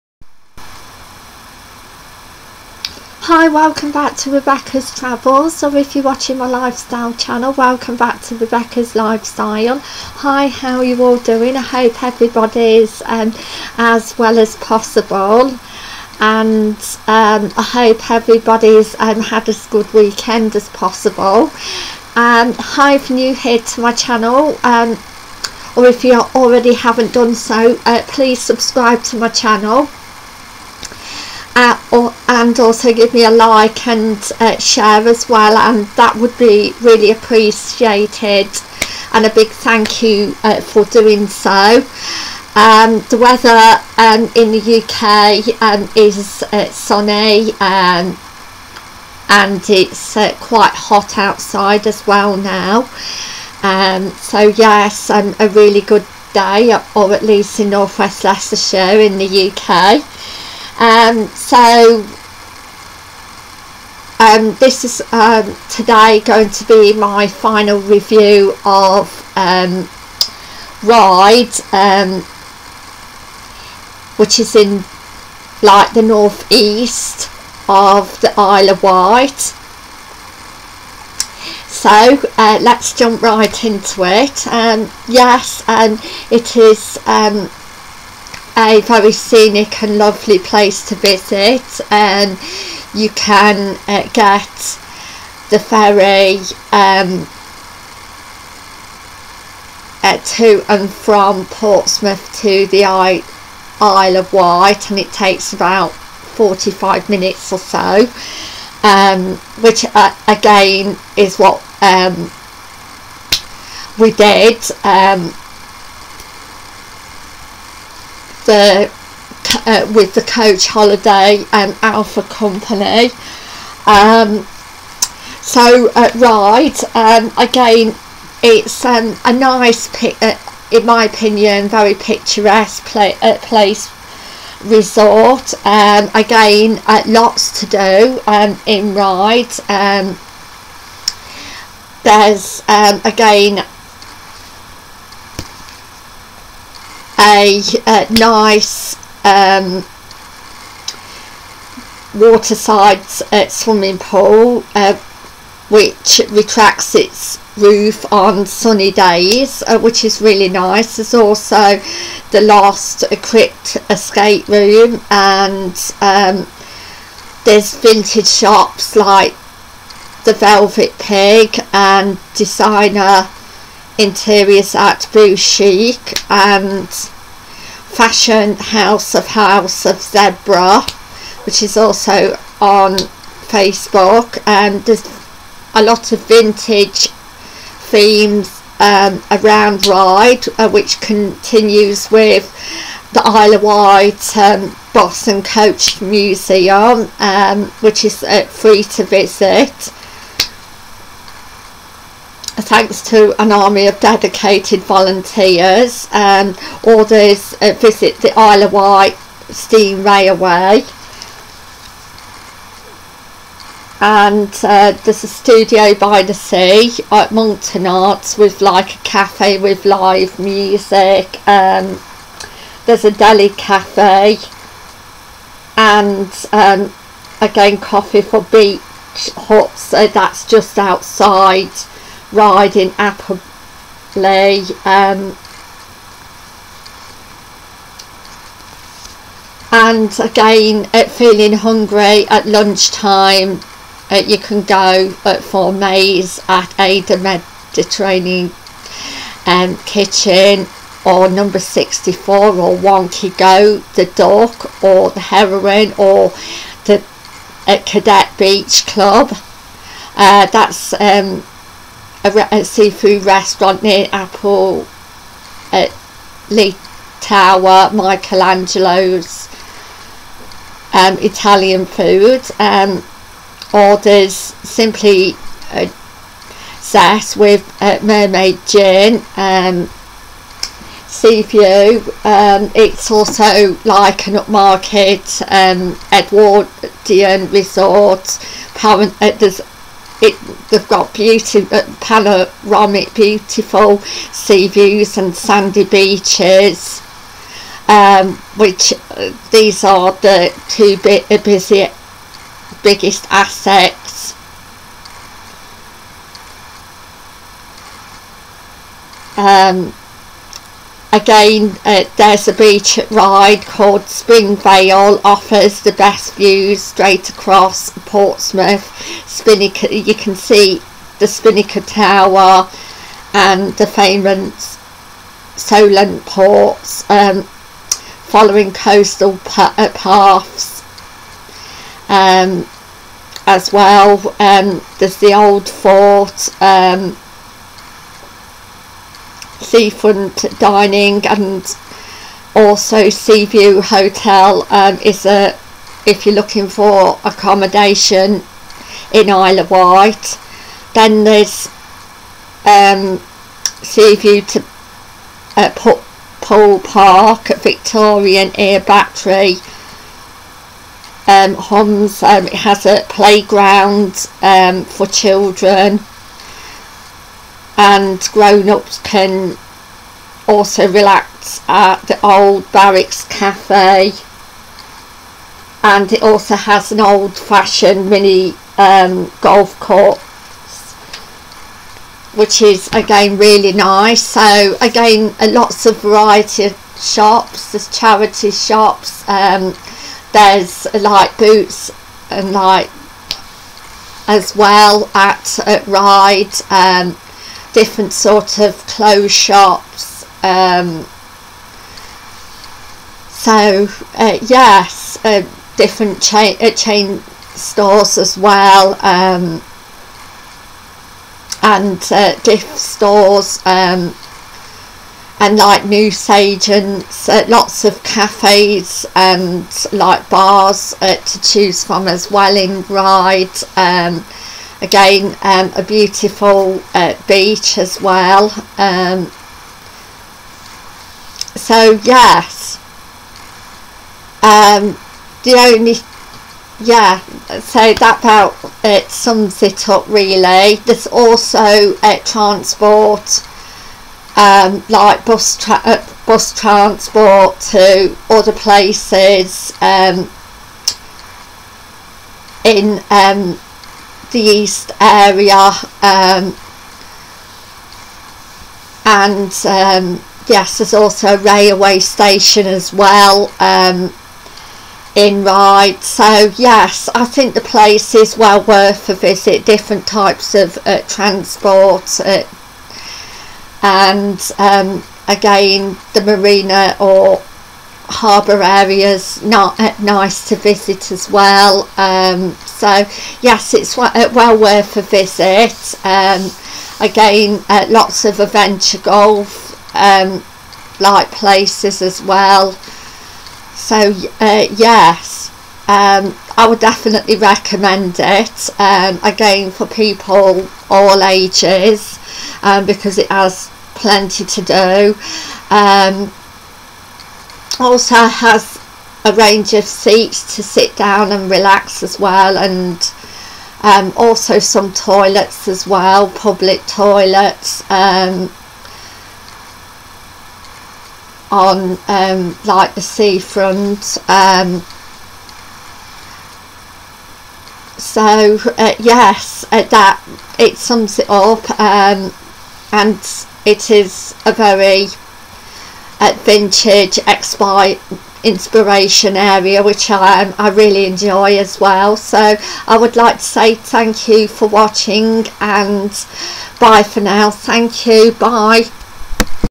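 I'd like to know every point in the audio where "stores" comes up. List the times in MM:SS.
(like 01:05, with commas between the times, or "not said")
06:47, 06:52.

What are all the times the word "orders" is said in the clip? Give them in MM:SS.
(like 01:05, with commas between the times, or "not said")
03:26, 04:33.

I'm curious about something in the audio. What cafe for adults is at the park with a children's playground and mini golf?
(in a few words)
Old Barracks Cafe.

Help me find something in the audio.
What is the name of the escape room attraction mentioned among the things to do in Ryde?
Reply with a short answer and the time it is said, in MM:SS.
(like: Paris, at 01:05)
The Last Crypt, at 02:42.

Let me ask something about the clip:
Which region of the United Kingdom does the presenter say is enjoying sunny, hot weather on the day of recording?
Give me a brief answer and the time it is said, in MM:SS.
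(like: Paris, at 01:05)
northwest Leicestershire, at 00:57.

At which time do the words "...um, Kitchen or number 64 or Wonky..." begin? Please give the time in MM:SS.
04:09.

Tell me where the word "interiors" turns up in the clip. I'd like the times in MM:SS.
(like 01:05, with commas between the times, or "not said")
02:53.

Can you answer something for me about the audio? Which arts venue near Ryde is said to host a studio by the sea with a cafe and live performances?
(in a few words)
Monkton Arts.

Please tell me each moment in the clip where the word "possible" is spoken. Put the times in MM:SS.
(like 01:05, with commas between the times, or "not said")
00:14, 00:20.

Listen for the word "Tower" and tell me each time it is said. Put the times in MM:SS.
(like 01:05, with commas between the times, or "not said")
04:27, 05:21.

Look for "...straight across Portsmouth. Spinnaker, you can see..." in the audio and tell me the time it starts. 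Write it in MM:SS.
05:16.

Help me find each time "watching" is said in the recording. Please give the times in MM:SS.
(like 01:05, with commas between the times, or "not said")
00:06, 09:04.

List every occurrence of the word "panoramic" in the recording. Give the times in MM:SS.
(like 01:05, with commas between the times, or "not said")
04:51.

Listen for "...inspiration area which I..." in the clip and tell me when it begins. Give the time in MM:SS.
08:58.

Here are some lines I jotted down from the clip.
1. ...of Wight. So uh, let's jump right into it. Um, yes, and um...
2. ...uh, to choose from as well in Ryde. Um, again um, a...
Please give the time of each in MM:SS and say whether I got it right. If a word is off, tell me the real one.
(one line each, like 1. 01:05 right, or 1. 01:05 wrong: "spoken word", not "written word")
1. 01:18 right
2. 07:01 right.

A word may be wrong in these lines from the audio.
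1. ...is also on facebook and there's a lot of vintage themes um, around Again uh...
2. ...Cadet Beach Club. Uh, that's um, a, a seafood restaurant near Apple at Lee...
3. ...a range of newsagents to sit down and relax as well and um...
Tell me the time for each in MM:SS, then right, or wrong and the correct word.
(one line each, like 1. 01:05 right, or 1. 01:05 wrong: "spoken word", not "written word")
1. 03:01 wrong: "Ryde", not "Again"
2. 04:17 right
3. 08:29 wrong: "seats", not "newsagents".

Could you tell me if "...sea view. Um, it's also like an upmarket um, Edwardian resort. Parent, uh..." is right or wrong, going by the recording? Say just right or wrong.
right.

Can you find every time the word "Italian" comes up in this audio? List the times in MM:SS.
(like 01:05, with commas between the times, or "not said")
04:31.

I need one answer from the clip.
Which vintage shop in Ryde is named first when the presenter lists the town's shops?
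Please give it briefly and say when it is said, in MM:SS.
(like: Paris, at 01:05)
The Velvet Pig, at 02:50.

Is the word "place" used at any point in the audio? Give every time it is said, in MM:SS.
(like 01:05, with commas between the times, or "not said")
01:30, 02:13, 07:28, 07:47, 08:11.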